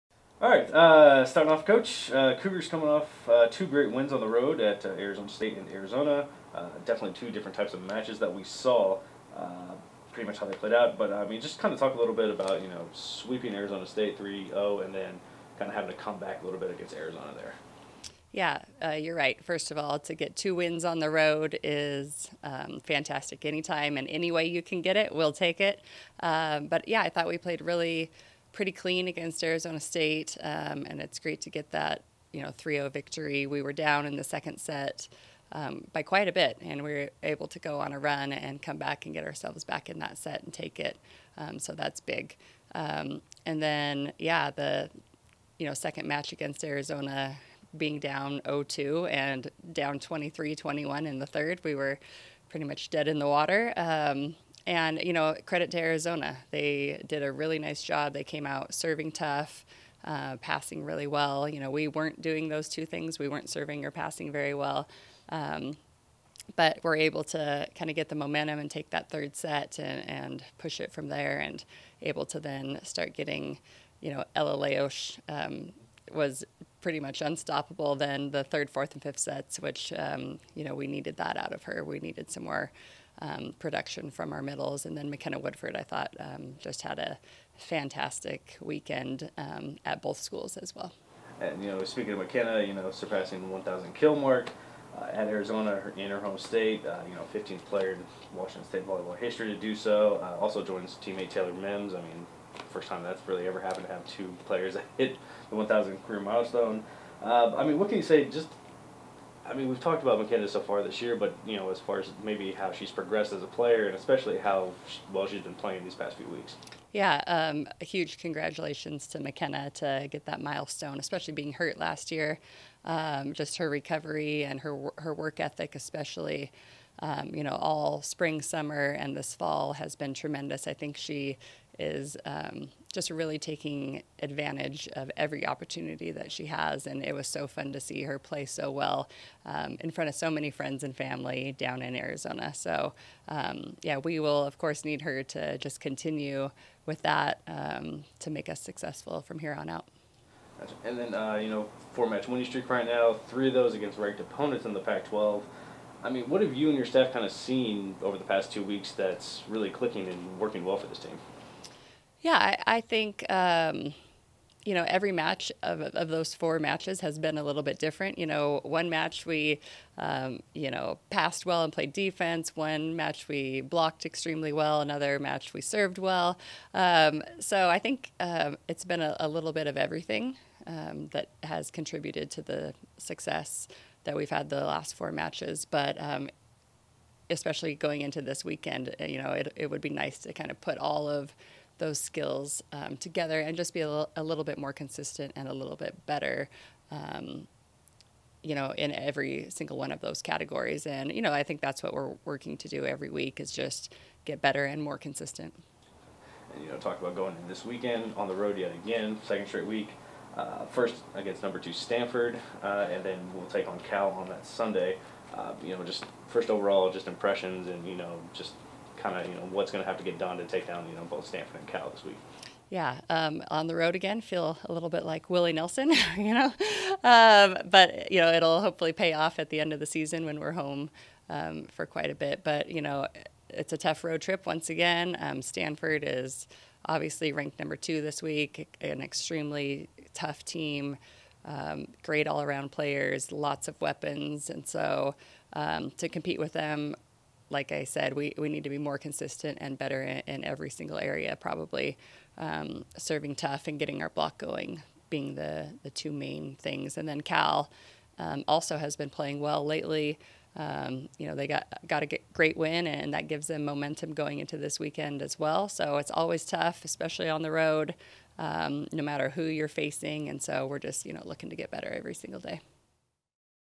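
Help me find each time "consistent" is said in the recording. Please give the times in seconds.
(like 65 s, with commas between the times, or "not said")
194 s, 204 s, 248 s.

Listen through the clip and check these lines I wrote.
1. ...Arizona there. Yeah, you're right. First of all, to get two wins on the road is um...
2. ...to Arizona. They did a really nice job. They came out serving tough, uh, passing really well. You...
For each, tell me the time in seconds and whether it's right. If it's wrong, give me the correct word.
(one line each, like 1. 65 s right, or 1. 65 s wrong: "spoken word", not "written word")
1. 16 s right
2. 55 s right.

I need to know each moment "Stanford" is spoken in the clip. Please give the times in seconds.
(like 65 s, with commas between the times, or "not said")
211 s, 221 s, 235 s.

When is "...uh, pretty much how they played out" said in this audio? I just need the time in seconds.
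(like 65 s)
9 s.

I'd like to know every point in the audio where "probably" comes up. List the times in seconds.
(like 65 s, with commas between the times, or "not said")
251 s.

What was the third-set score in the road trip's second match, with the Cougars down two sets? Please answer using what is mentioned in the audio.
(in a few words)
23-21.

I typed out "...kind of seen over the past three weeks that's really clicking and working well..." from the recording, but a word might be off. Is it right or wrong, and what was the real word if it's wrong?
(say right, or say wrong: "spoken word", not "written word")
wrong: "two", not "three".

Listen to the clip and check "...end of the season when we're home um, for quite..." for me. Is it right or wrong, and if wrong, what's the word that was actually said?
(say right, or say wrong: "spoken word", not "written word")
right.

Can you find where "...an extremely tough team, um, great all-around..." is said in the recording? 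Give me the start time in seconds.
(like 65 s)
238 s.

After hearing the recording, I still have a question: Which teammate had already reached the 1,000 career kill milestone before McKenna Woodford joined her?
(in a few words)
Taylor Mims.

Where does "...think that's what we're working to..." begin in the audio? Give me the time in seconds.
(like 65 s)
201 s.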